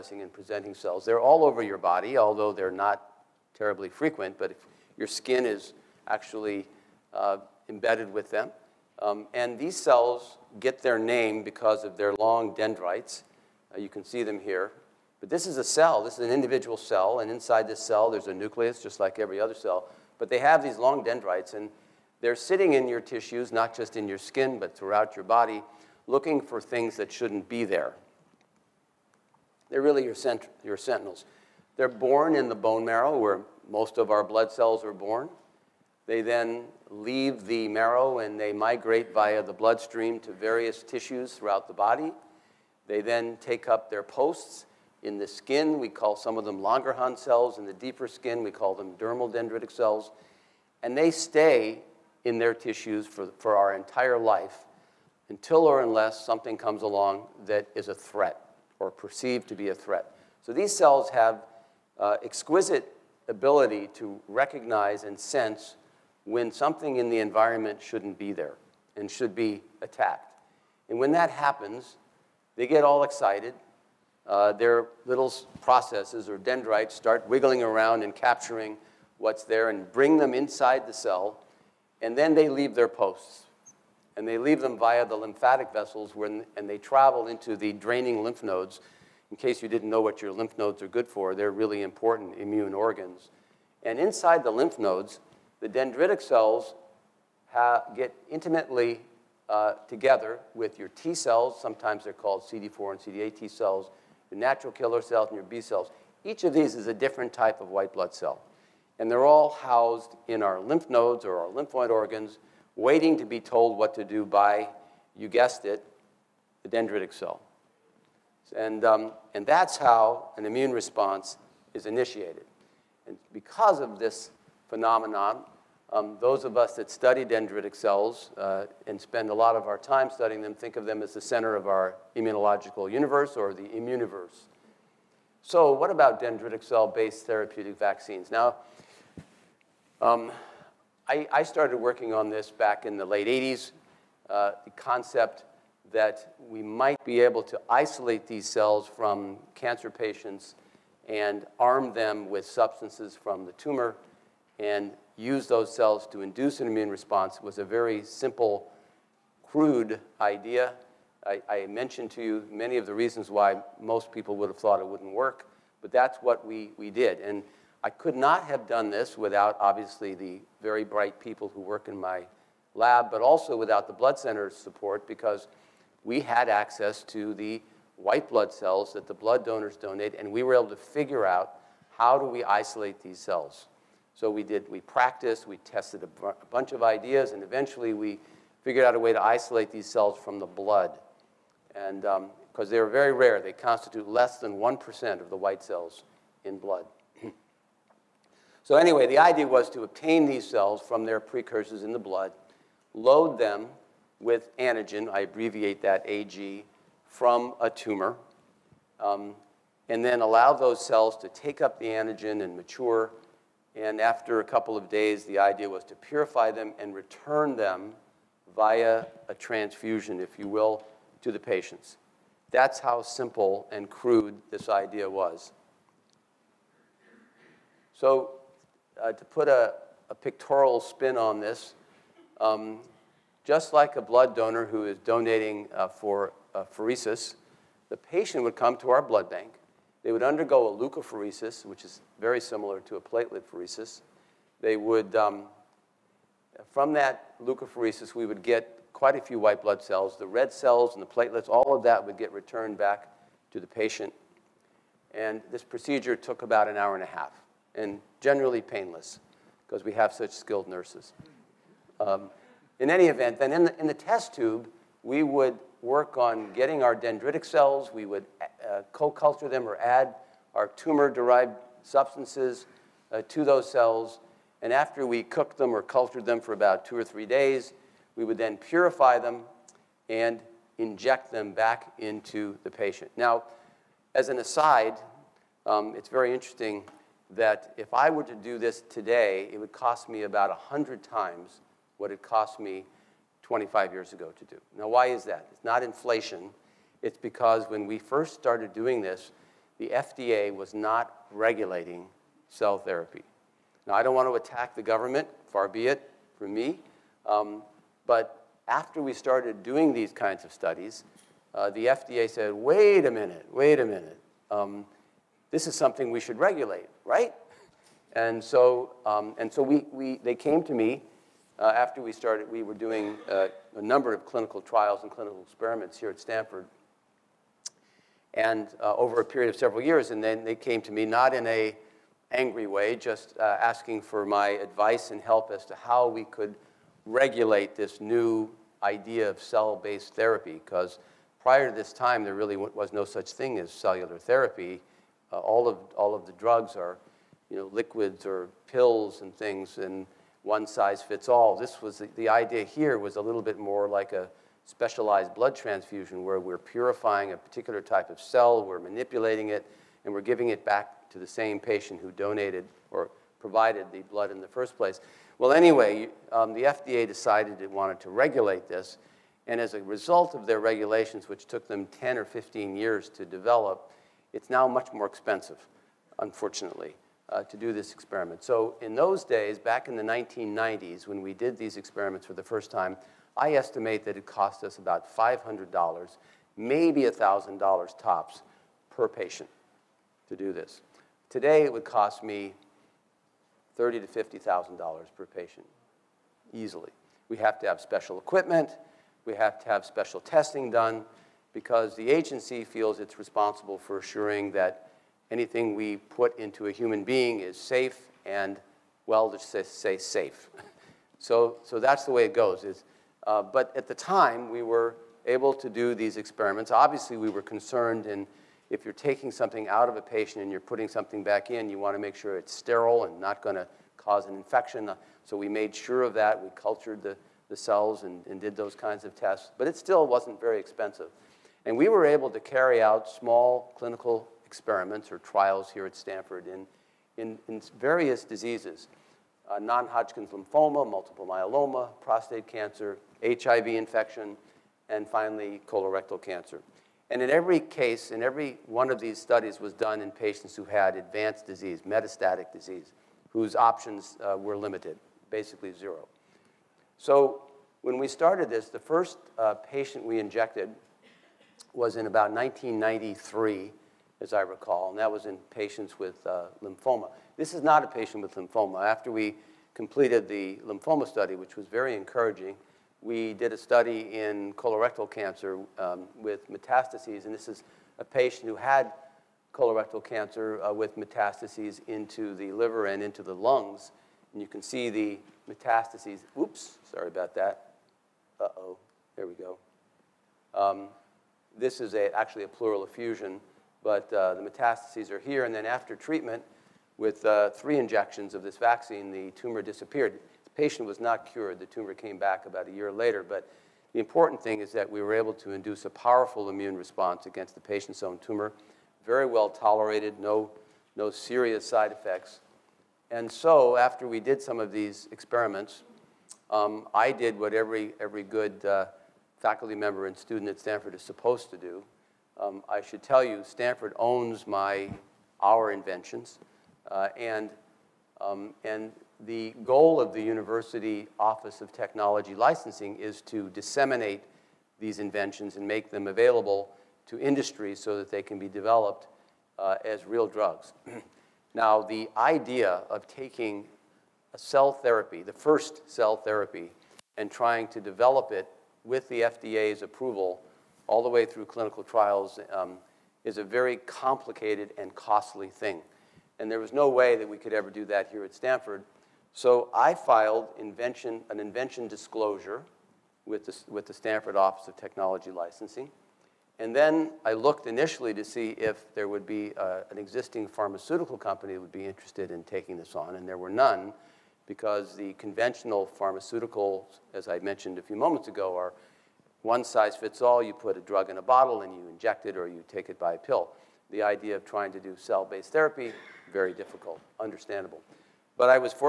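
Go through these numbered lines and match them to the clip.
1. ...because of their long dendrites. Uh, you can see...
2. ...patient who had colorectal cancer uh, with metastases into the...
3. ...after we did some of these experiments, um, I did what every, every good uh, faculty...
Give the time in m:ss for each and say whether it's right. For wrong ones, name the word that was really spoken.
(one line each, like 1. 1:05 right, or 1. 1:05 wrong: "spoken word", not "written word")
1. 0:11 right
2. 7:58 right
3. 8:33 right.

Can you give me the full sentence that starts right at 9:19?
So I filed invention, an invention disclosure with the, with the Stanford Office of Technology Licensing.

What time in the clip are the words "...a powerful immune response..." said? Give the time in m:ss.
8:25.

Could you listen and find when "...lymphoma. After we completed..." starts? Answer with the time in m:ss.
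7:48.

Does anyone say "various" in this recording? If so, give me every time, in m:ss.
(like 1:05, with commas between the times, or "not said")
0:40, 7:17.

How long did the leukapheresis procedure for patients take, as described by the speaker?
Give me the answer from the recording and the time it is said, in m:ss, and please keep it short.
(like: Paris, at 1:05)
an hour and a half, at 4:16.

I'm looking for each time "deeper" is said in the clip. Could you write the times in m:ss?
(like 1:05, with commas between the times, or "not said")
0:47.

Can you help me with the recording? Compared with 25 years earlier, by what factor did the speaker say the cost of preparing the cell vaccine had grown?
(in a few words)
100 times.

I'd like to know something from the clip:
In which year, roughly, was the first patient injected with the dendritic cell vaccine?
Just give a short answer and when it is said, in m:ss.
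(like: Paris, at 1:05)
1993, at 7:42.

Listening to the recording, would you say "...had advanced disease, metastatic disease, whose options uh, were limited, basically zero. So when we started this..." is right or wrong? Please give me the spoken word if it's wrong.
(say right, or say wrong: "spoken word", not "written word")
right.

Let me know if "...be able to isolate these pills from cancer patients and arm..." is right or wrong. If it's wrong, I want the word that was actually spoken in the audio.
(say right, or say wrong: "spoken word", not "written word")
wrong: "cells", not "pills".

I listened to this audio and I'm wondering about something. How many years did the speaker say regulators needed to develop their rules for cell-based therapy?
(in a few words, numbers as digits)
10 or 15 years.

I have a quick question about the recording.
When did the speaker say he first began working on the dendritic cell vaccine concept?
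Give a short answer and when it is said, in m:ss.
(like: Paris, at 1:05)
late 80s, at 2:23.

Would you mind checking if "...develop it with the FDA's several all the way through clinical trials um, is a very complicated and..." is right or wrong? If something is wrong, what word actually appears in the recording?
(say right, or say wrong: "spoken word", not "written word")
wrong: "approval", not "several".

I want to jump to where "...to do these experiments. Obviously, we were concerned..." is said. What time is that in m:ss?
6:55.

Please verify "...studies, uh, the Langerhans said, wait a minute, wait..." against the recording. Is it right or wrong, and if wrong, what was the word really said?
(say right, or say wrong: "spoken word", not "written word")
wrong: "FDA", not "Langerhans".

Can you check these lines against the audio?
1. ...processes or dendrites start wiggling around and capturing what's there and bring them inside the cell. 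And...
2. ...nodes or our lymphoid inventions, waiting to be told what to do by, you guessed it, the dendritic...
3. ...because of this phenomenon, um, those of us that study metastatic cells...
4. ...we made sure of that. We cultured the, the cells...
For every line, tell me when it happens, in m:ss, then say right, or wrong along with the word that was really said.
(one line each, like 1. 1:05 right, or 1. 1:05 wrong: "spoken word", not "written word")
1. 1:15 right
2. 1:50 wrong: "organs", not "inventions"
3. 2:03 wrong: "dendritic", not "metastatic"
4. 7:05 right.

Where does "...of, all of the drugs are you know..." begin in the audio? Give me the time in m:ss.
5:45.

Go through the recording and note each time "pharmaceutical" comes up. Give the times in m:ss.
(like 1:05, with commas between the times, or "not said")
9:30, 9:35.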